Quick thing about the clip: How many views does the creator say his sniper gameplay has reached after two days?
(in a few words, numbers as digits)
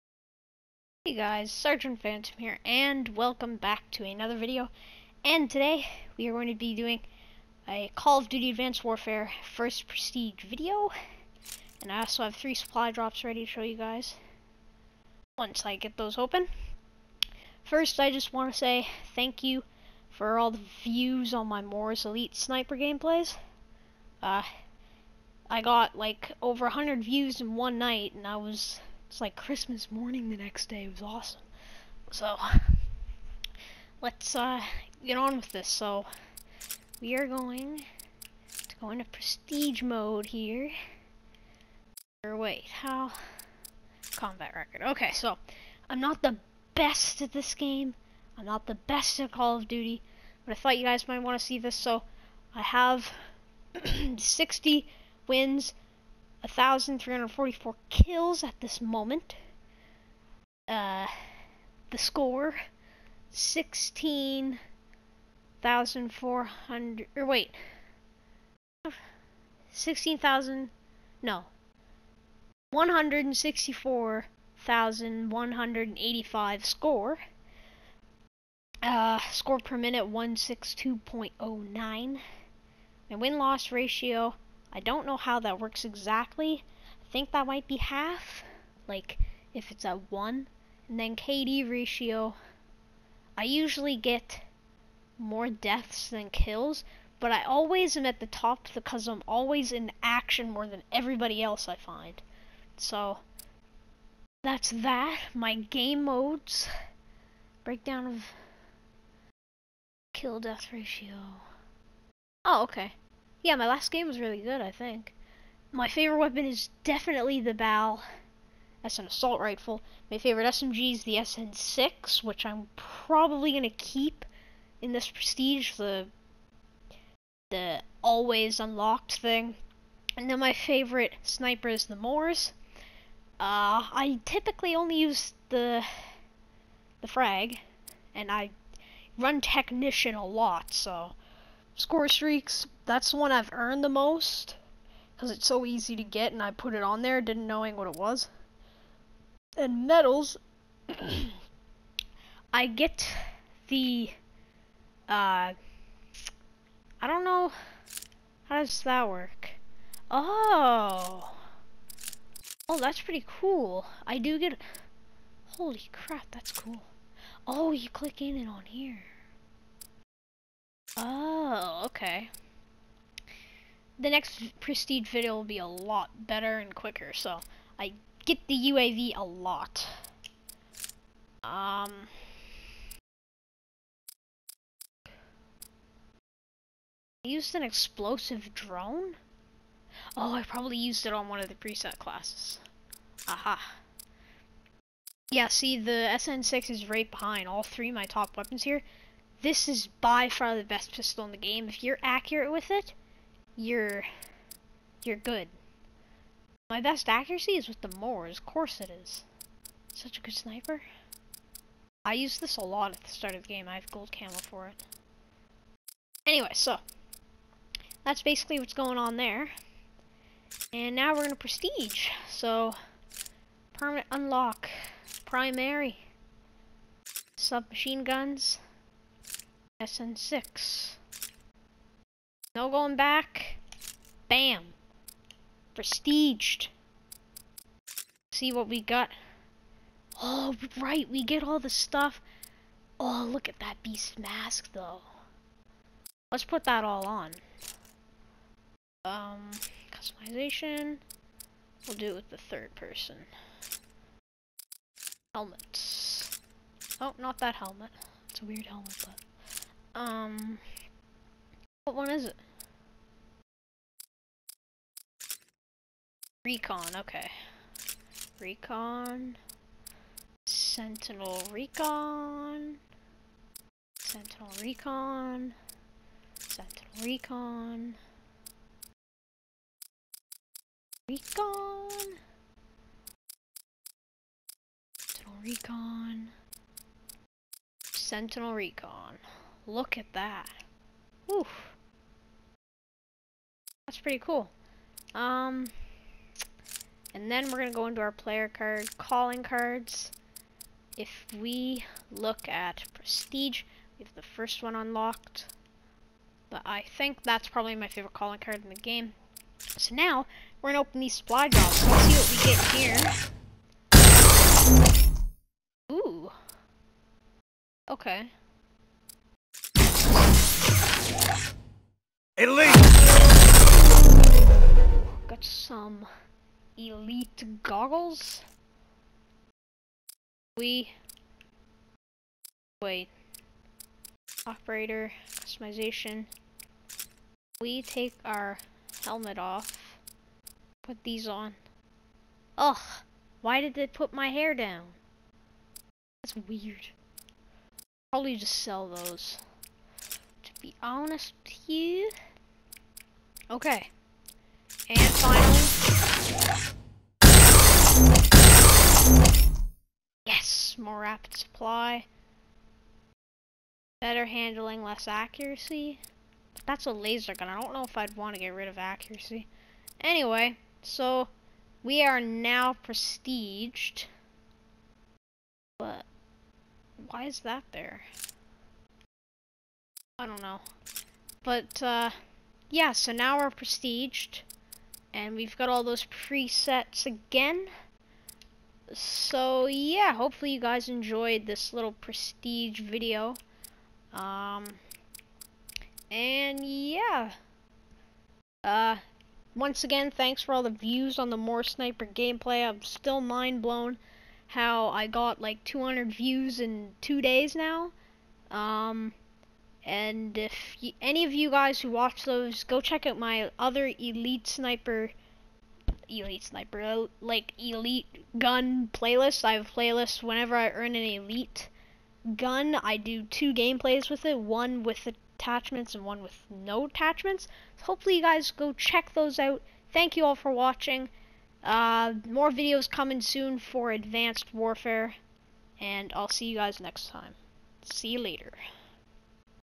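200.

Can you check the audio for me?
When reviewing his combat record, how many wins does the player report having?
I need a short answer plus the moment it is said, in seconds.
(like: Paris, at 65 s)
60, at 54 s.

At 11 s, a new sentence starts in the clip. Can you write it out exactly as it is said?
And I also have three supply drops ready to show you guys once I get those open.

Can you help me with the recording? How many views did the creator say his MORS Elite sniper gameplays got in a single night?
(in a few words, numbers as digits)
over 100.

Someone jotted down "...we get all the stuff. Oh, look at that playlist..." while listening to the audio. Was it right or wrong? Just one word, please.
wrong.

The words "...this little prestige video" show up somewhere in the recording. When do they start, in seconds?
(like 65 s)
391 s.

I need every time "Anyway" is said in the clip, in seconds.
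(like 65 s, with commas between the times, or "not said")
216 s, 369 s.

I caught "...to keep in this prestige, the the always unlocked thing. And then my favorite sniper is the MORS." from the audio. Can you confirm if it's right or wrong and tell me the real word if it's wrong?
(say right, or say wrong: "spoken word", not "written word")
right.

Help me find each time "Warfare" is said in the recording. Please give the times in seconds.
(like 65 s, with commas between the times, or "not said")
8 s, 434 s.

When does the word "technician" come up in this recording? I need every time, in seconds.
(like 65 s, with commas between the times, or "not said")
139 s.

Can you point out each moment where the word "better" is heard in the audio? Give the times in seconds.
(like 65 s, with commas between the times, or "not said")
176 s, 363 s.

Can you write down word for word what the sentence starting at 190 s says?
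Oh, I probably used it on one of the preset classes.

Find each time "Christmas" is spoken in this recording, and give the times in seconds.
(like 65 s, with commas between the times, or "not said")
29 s.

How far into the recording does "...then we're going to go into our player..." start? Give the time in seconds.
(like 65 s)
297 s.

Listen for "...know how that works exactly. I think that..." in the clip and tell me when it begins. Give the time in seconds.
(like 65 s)
85 s.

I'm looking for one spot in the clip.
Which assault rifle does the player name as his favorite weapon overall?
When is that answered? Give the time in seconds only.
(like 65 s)
117 s.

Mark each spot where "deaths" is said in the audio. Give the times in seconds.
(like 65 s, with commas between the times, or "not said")
95 s, 110 s.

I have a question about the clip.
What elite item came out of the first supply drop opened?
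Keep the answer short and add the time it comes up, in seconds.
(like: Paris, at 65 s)
elite goggles, at 326 s.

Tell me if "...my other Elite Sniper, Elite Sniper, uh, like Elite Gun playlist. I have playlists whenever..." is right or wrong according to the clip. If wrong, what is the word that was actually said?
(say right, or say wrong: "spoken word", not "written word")
right.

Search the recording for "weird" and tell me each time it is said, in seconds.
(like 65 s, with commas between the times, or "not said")
258 s, 346 s.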